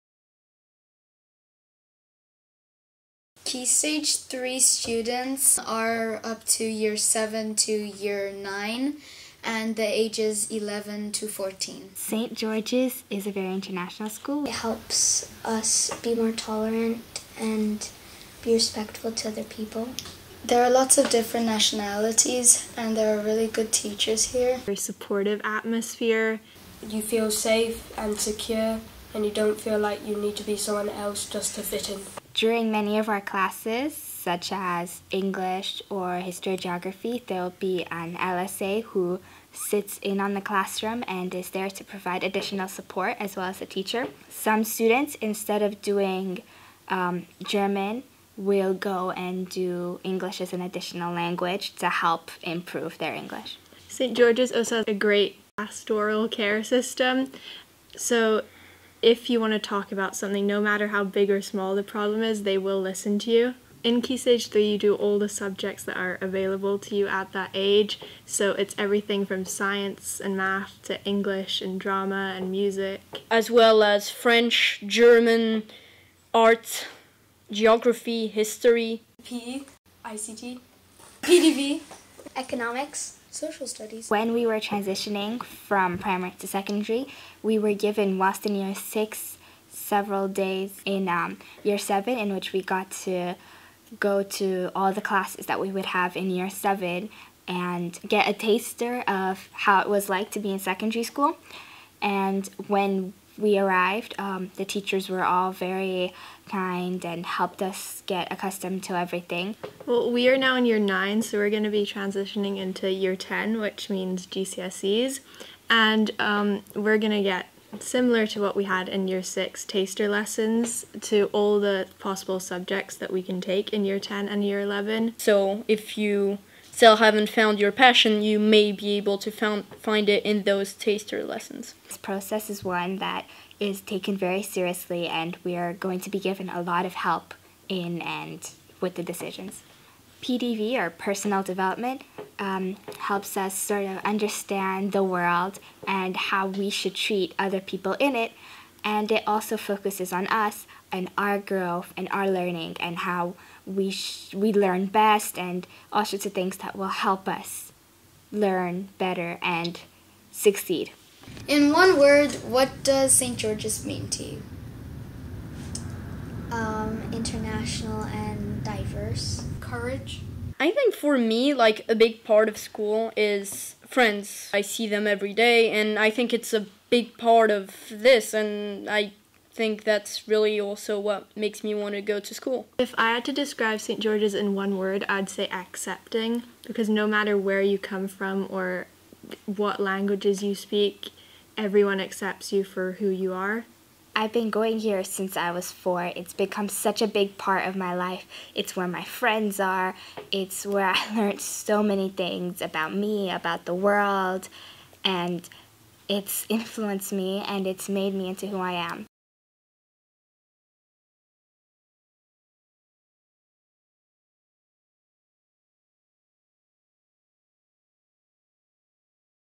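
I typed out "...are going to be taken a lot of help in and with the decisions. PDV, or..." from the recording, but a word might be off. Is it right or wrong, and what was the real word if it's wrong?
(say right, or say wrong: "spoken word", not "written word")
wrong: "given", not "taken".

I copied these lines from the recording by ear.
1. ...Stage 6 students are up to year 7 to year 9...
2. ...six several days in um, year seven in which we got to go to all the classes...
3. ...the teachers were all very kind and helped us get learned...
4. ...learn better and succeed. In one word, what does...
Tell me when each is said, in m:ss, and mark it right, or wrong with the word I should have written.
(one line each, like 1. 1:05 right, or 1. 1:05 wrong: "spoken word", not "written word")
1. 0:03 wrong: "3", not "6"
2. 1:28 right
3. 1:44 wrong: "accustomed", not "learned"
4. 2:38 right.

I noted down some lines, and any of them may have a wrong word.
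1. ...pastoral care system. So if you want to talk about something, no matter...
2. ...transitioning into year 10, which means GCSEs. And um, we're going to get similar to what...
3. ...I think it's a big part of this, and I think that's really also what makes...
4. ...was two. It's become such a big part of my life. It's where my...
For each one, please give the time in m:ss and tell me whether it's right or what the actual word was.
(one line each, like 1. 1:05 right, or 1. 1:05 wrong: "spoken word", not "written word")
1. 0:55 right
2. 1:51 right
3. 2:55 right
4. 3:15 wrong: "four", not "two".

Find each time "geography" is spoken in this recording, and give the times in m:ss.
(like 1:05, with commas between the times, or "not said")
0:36, 1:17.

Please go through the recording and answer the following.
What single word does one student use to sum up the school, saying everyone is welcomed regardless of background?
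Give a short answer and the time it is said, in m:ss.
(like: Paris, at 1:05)
Accepting, at 3:05.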